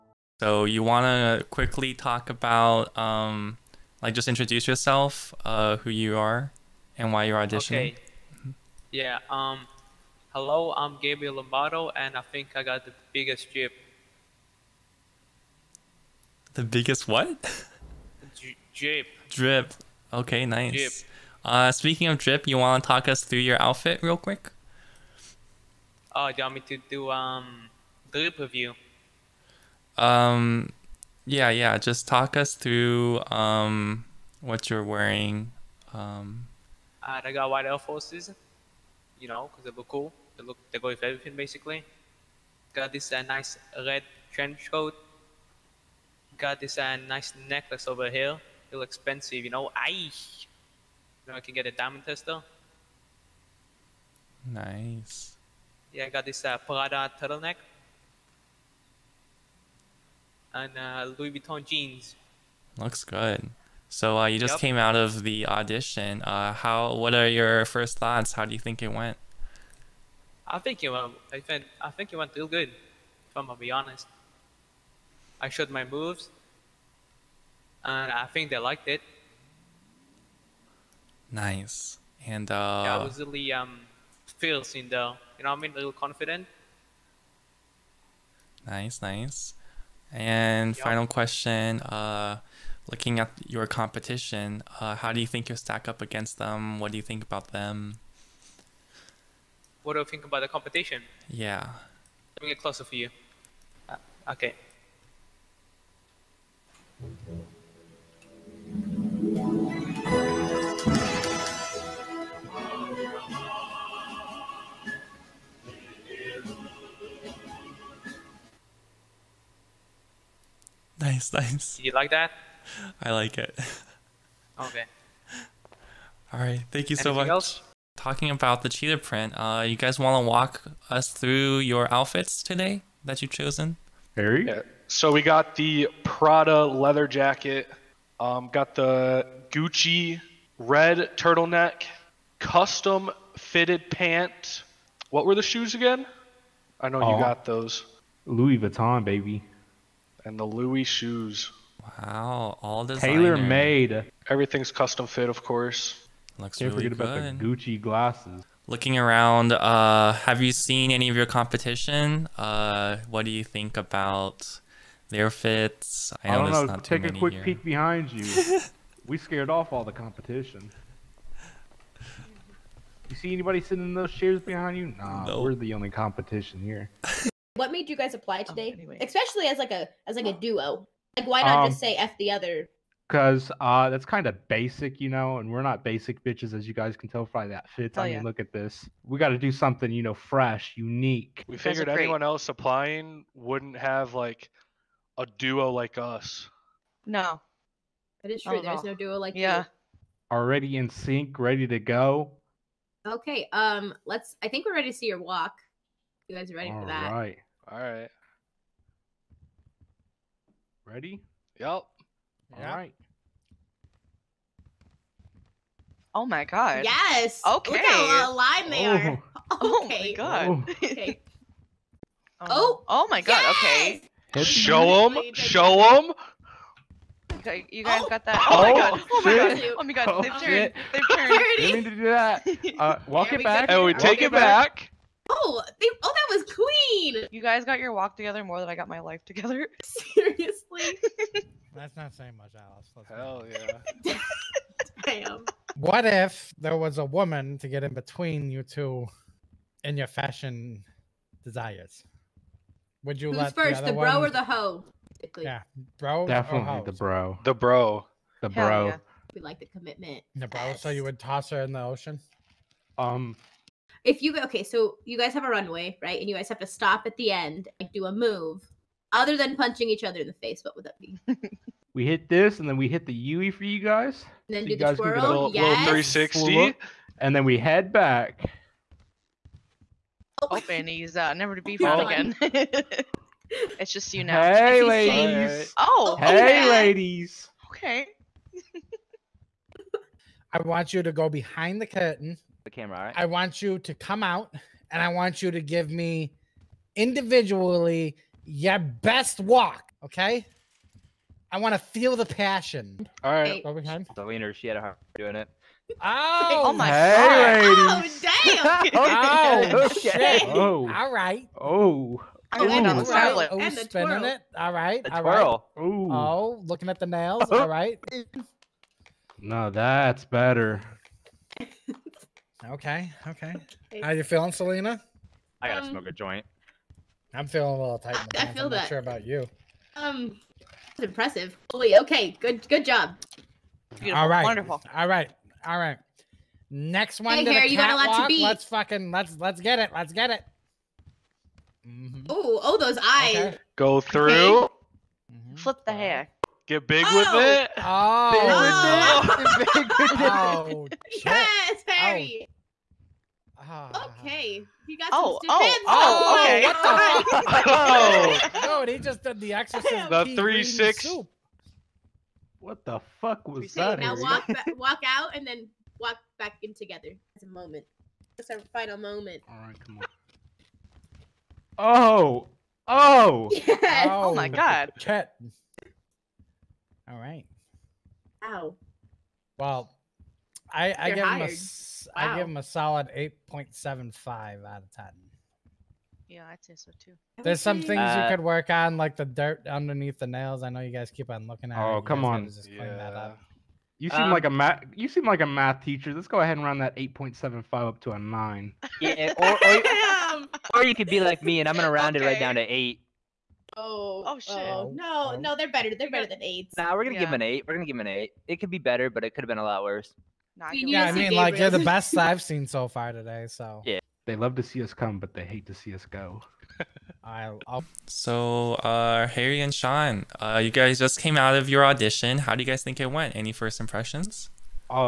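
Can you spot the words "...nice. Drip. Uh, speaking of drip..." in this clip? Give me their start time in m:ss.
0:20.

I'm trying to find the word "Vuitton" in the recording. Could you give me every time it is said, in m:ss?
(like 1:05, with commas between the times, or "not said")
1:01, 2:28.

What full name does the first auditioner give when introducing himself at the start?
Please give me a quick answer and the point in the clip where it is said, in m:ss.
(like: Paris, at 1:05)
Gabriel Lombardo, at 0:11.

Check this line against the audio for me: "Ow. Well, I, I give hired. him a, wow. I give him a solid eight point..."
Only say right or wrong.
right.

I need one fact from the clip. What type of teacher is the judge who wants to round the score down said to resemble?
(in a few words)
Math teacher.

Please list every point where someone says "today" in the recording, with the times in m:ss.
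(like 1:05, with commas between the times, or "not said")
2:12, 2:58, 6:53.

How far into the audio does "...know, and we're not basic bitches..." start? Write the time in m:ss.
3:05.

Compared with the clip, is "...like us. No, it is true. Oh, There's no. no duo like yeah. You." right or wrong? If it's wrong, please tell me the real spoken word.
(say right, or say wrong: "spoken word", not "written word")
right.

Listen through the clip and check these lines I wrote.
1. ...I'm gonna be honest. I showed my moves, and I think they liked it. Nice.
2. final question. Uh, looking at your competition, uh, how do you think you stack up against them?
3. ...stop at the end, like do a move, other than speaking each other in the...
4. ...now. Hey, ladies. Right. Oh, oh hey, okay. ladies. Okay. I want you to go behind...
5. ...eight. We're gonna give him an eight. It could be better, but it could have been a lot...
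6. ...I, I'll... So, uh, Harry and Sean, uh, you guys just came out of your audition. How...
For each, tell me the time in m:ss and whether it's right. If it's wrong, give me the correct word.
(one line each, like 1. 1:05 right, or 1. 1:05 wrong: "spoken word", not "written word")
1. 1:13 right
2. 1:30 right
3. 4:26 wrong: "punching", not "speaking"
4. 4:44 right
5. 6:47 right
6. 6:57 right.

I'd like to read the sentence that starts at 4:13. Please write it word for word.
Would you Who's let first, the, the bro one...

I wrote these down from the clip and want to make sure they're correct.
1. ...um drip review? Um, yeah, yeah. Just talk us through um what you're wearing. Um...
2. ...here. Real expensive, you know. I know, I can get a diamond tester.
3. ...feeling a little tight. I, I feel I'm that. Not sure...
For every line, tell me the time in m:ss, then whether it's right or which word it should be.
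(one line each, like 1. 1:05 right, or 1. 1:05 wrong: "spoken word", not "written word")
1. 0:27 right
2. 0:48 right
3. 5:27 right.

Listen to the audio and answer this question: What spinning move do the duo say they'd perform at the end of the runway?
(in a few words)
360.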